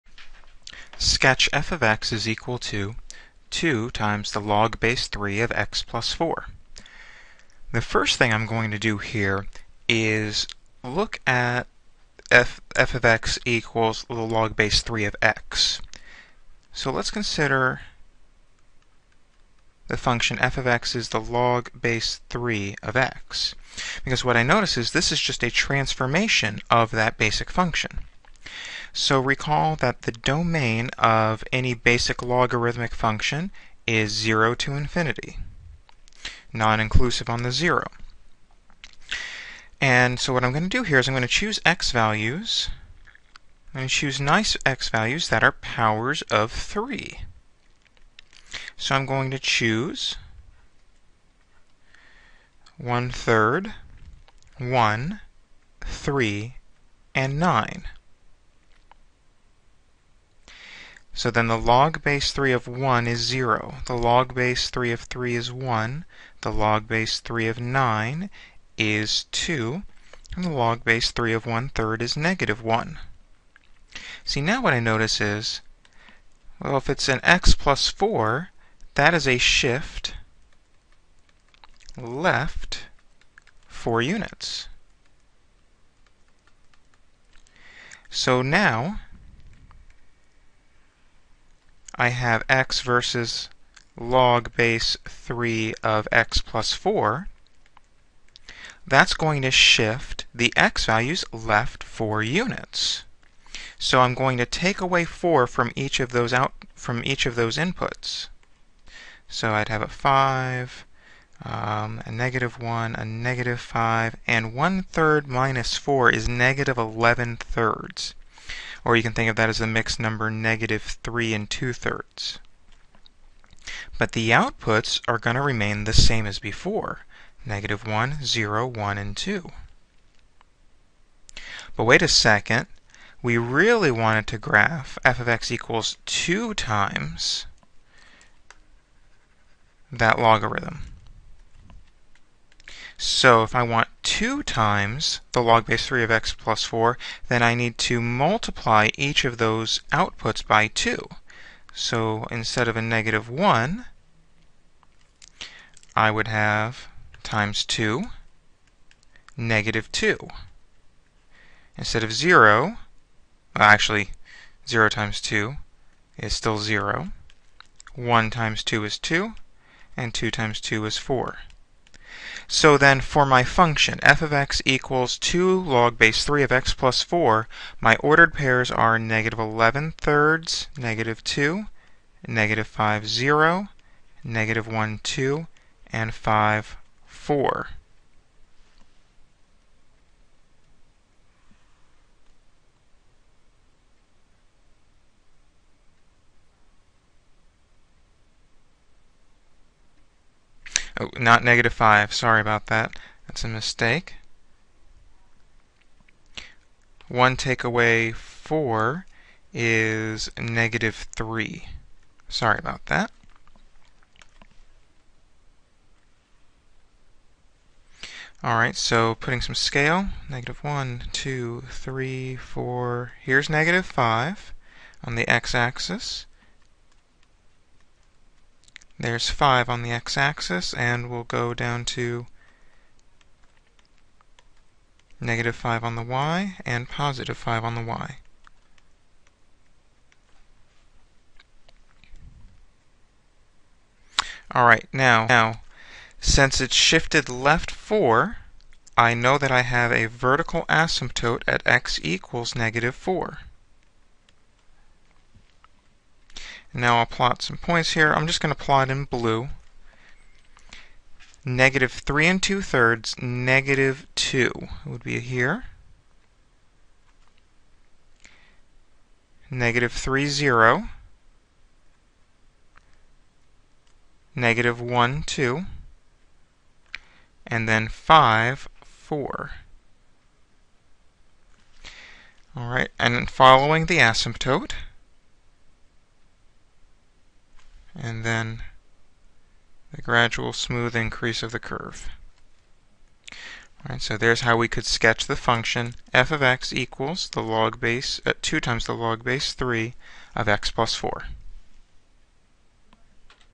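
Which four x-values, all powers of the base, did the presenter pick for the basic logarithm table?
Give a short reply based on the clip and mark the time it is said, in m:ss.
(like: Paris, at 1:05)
1/3, 1, 3, and 9, at 0:52.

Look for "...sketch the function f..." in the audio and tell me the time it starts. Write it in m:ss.
4:54.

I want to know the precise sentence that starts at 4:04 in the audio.
Alright, now, now, since it's shifted left 4, I know that I have a vertical asymptote at x equals negative 4.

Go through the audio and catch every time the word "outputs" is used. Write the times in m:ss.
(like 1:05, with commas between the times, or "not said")
2:04, 2:29.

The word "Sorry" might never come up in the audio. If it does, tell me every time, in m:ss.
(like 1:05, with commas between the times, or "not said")
3:22, 3:32.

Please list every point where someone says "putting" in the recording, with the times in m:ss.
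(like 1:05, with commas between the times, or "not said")
3:39.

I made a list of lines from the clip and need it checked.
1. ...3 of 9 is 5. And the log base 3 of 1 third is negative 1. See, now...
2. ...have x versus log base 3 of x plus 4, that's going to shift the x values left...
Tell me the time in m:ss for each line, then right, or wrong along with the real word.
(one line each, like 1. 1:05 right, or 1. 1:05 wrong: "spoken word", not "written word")
1. 1:07 wrong: "2", not "5"
2. 1:32 right.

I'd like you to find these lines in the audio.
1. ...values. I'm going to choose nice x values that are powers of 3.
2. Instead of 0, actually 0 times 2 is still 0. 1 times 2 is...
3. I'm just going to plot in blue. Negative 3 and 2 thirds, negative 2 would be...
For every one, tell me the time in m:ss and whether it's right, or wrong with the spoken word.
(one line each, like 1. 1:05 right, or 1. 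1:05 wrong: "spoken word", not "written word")
1. 0:41 right
2. 2:41 right
3. 4:18 right.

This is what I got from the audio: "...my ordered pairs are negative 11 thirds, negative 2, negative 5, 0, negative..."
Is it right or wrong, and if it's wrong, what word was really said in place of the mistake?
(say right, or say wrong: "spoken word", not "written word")
right.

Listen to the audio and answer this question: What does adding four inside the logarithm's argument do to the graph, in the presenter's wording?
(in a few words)
shift left 4 units.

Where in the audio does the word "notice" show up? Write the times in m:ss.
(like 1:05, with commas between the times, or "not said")
0:24, 1:14.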